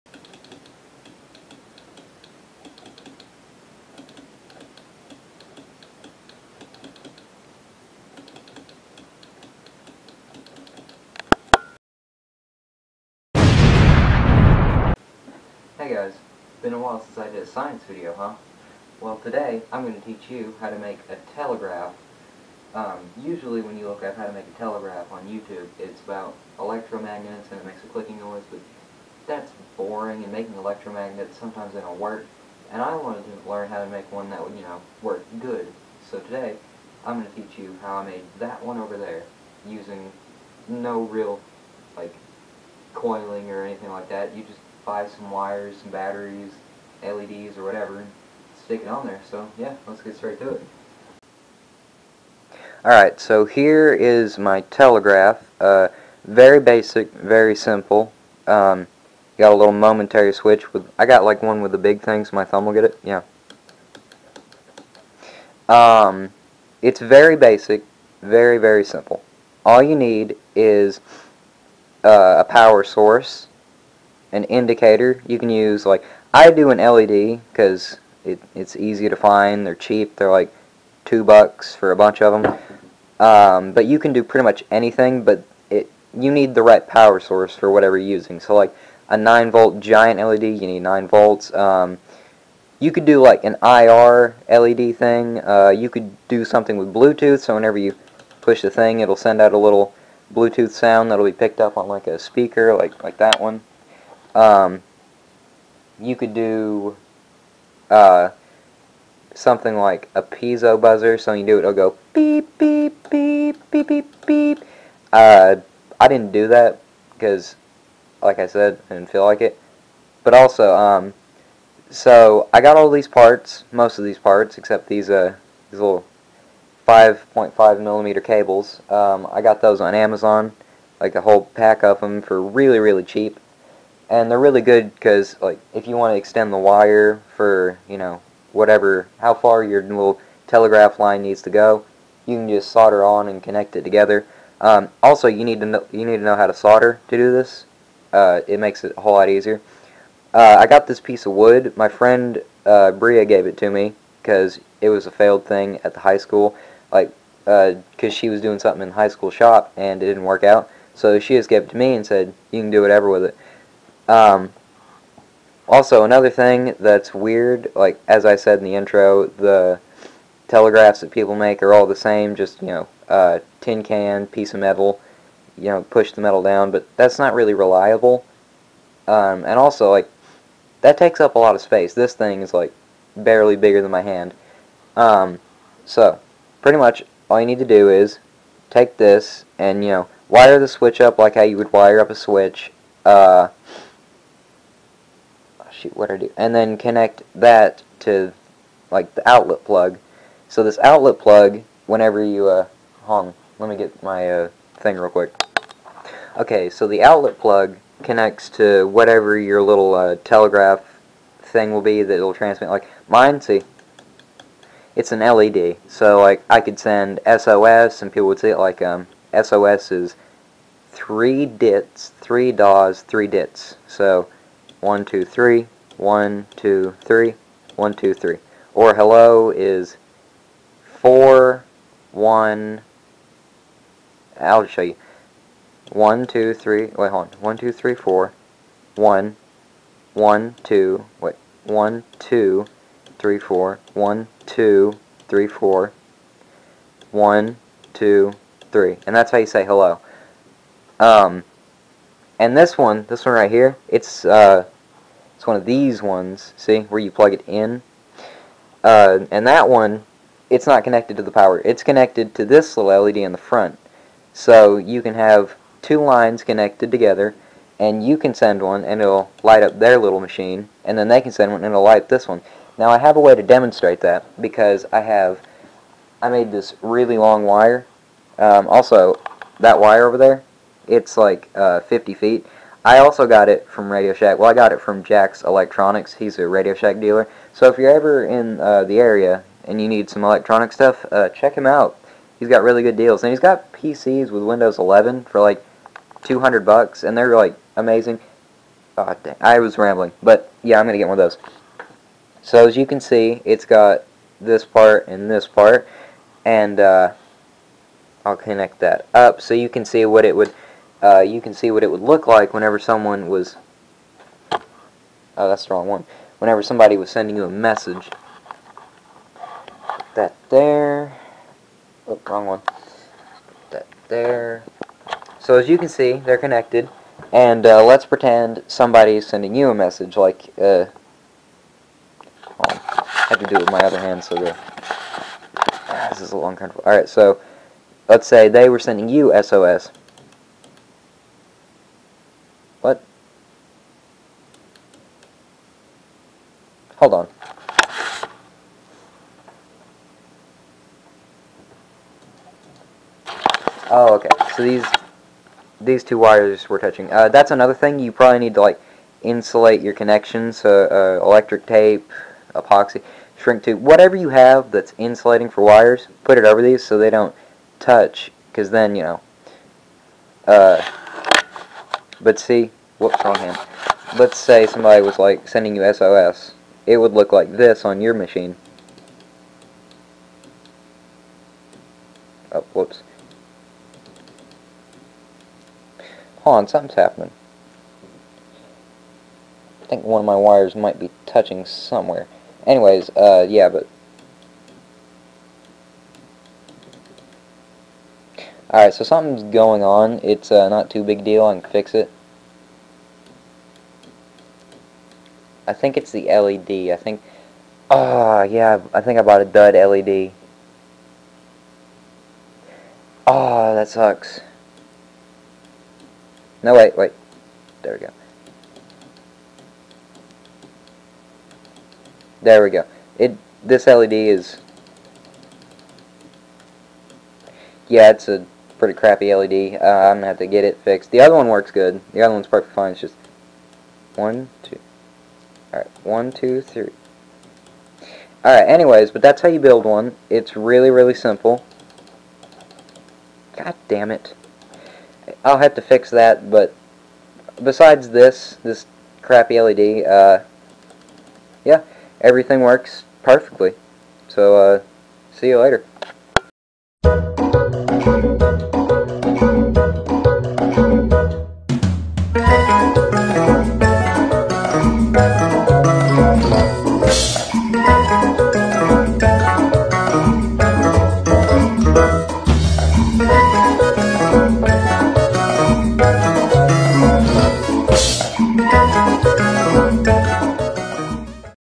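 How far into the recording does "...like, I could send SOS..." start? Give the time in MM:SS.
03:36.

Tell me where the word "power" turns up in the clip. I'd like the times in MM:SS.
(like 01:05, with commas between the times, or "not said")
01:12, 01:26, 04:21.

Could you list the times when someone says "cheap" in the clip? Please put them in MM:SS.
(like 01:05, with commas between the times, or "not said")
01:19, 02:13.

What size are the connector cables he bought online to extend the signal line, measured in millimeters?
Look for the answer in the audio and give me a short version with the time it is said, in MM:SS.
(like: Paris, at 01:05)
5.5 millimeter, at 02:06.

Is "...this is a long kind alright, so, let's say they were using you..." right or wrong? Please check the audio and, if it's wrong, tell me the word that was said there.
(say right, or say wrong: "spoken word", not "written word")
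wrong: "sending", not "using".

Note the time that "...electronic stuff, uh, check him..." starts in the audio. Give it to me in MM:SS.
04:50.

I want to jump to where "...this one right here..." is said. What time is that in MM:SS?
04:13.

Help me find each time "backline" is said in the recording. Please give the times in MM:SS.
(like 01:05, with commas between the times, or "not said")
not said.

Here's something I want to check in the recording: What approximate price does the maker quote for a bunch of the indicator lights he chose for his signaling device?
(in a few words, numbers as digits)
2 bucks.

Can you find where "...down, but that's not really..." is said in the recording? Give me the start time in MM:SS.
02:56.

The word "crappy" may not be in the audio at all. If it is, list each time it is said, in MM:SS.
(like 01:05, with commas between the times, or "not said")
07:08, 07:29.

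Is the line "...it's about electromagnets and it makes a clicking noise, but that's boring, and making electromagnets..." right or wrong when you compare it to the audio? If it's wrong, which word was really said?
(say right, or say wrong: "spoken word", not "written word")
right.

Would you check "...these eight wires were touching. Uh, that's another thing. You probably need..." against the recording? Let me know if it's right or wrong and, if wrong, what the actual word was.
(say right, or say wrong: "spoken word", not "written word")
wrong: "two", not "eight".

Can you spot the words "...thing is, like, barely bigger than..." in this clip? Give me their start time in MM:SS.
03:02.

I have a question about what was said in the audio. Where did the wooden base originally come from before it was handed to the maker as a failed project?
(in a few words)
high school shop.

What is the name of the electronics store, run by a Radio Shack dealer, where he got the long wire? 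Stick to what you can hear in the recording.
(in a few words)
Jack's Electronics.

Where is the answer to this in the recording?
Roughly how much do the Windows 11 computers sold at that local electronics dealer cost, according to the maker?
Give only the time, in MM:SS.
04:56.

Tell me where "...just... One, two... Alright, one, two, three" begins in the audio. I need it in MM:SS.
07:12.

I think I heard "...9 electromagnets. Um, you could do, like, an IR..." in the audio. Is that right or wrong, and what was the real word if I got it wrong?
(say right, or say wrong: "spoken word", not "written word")
wrong: "volts", not "electromagnets".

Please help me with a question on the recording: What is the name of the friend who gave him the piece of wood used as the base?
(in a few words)
Bria.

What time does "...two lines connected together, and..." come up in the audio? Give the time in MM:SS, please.
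04:25.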